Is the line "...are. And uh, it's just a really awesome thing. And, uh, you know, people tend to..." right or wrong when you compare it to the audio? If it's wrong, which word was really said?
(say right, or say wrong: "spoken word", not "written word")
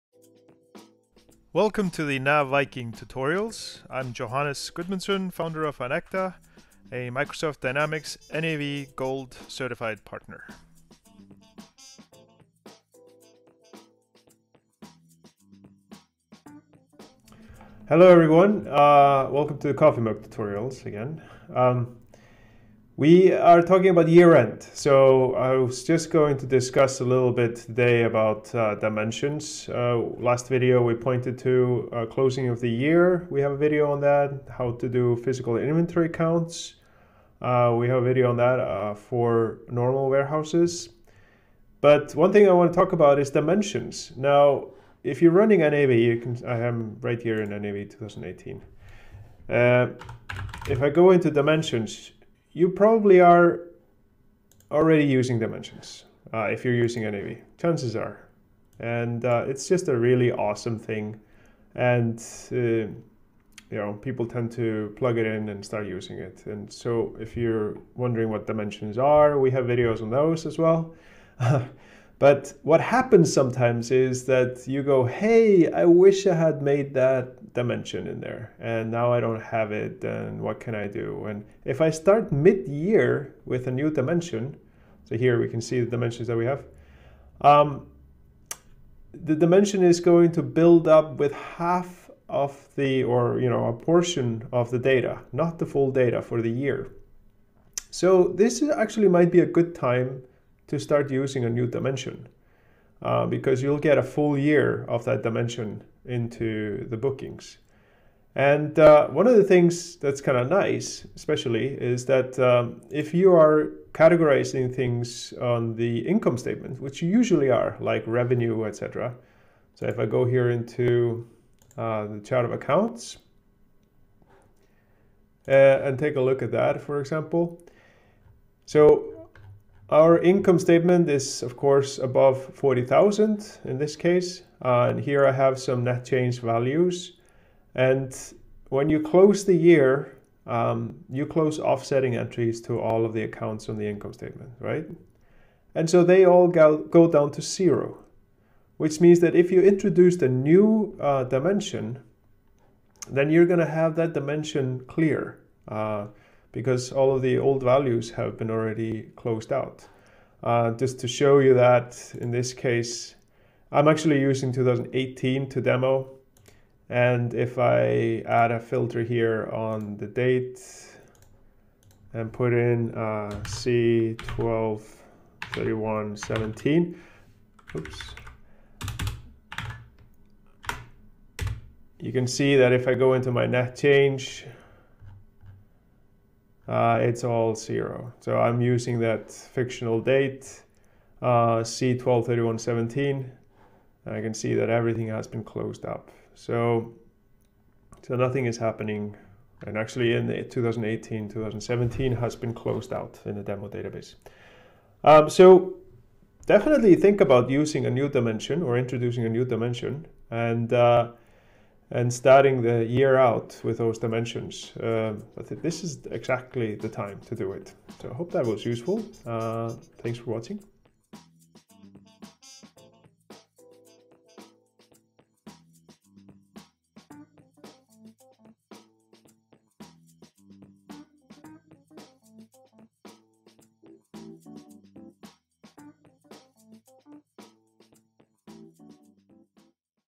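right.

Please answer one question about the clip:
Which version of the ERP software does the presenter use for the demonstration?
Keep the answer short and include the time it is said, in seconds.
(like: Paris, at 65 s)
NAV 2018, at 47 s.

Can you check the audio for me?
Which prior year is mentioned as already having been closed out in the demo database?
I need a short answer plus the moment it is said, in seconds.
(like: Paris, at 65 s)
2017, at 201 s.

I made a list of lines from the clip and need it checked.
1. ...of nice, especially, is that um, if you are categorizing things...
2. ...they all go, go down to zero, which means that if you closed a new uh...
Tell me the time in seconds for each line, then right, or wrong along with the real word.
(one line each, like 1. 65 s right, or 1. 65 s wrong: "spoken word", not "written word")
1. 110 s right
2. 146 s wrong: "introduced", not "closed".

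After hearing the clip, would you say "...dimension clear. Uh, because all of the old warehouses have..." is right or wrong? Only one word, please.
wrong.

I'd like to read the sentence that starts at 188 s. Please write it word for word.
So I'm using that fictional date, uh, C123117, and I can see that everything has been closed up.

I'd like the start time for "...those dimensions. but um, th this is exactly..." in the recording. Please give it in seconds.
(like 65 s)
213 s.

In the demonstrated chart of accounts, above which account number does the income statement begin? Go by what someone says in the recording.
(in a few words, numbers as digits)
40,000.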